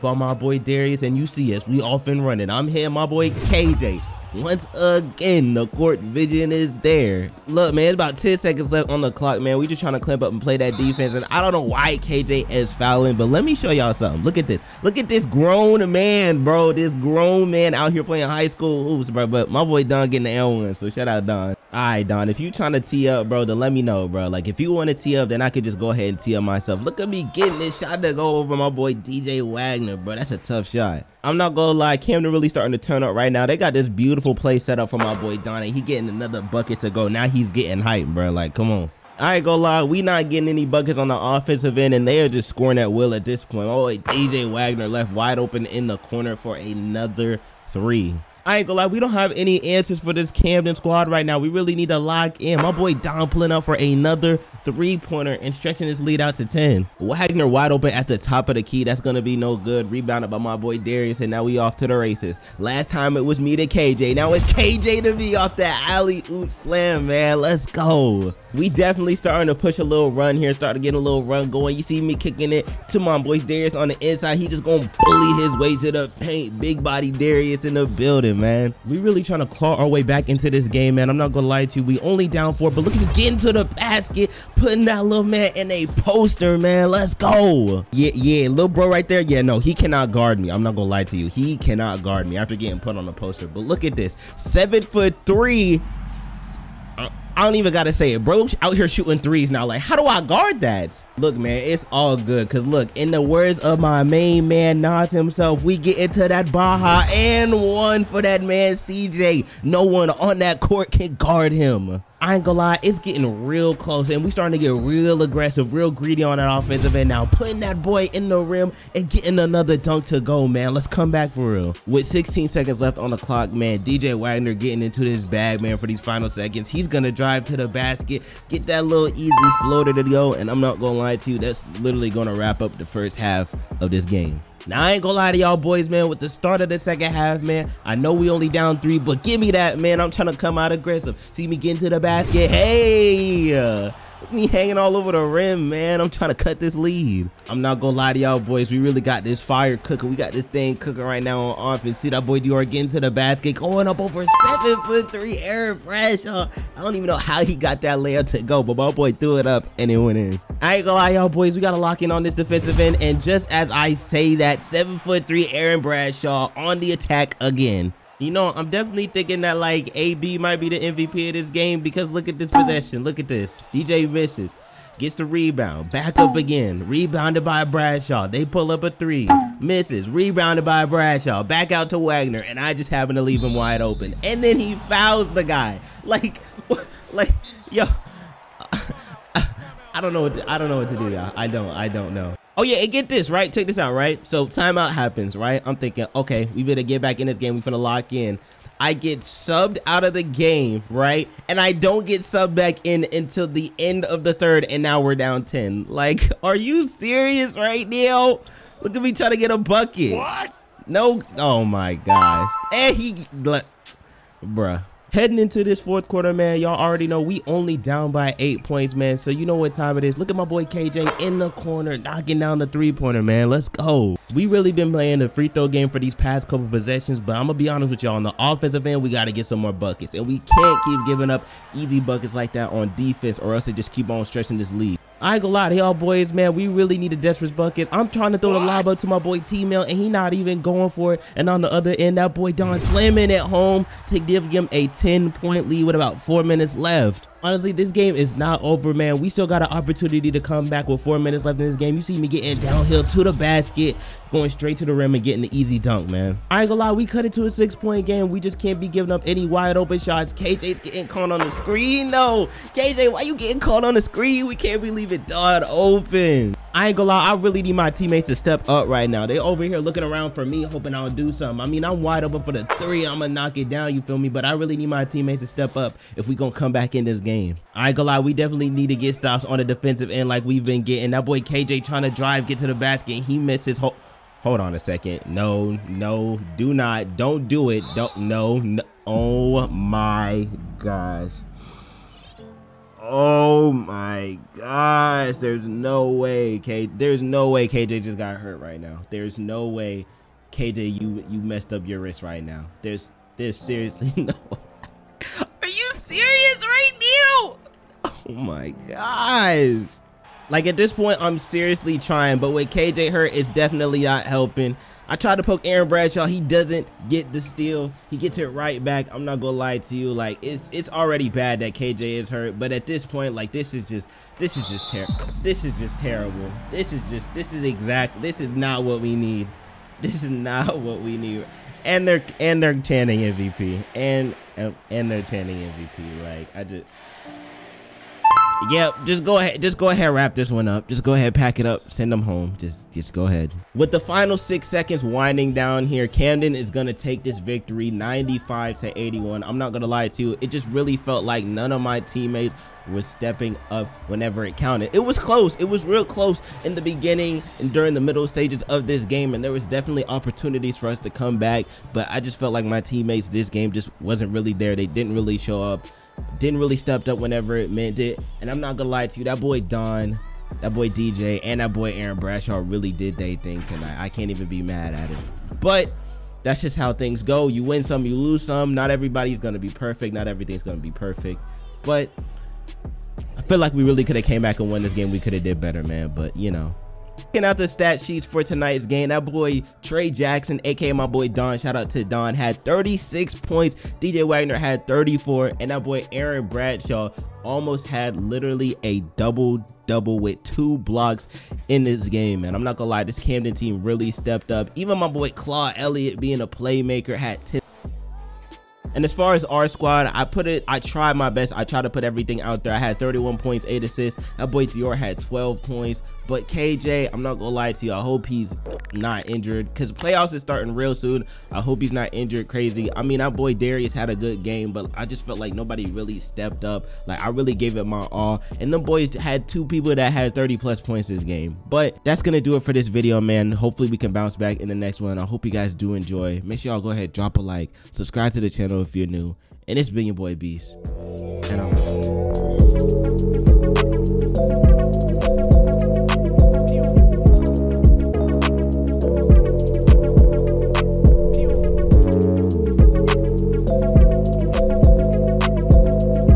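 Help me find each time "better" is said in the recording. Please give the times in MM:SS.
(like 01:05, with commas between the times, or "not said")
03:16, 06:25.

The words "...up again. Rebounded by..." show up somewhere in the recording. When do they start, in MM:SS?
02:56.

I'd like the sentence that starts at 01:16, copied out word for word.
Big body Darius in the building, man.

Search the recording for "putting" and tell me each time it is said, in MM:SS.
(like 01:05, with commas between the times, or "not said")
01:24, 01:57.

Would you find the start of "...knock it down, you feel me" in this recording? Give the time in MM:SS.
04:33.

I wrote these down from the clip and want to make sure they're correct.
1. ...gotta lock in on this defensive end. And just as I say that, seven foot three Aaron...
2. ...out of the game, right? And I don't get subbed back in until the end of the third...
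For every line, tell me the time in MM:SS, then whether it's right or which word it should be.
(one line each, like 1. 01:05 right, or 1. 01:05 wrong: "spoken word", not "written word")
1. 02:41 right
2. 03:19 right.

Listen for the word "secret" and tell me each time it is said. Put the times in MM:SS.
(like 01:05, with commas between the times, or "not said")
not said.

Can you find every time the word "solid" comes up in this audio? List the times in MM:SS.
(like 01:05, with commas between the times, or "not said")
not said.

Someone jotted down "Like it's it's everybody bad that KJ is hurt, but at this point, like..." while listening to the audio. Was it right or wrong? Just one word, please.
wrong.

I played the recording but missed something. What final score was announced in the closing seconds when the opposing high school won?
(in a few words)
95 to 81.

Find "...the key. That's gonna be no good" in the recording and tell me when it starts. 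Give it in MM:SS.
00:58.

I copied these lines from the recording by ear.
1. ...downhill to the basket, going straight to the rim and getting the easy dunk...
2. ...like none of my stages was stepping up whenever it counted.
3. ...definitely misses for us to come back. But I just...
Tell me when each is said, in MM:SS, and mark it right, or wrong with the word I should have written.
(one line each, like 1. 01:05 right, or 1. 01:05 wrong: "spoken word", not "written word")
1. 04:12 right
2. 05:51 wrong: "teammates", not "stages"
3. 05:59 wrong: "opportunities", not "misses".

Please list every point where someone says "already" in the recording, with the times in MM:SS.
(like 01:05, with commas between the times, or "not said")
03:36, 05:20.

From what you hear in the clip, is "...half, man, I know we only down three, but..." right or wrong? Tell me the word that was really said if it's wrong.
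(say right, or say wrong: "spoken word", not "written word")
right.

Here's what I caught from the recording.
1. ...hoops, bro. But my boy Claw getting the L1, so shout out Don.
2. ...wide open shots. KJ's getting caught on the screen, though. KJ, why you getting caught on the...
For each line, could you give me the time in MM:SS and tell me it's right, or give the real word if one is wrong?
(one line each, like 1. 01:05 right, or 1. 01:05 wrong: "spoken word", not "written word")
1. 00:18 wrong: "Don", not "Claw"
2. 04:19 right.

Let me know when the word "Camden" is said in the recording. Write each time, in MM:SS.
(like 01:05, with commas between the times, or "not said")
00:31, 00:50, 05:46, 06:43.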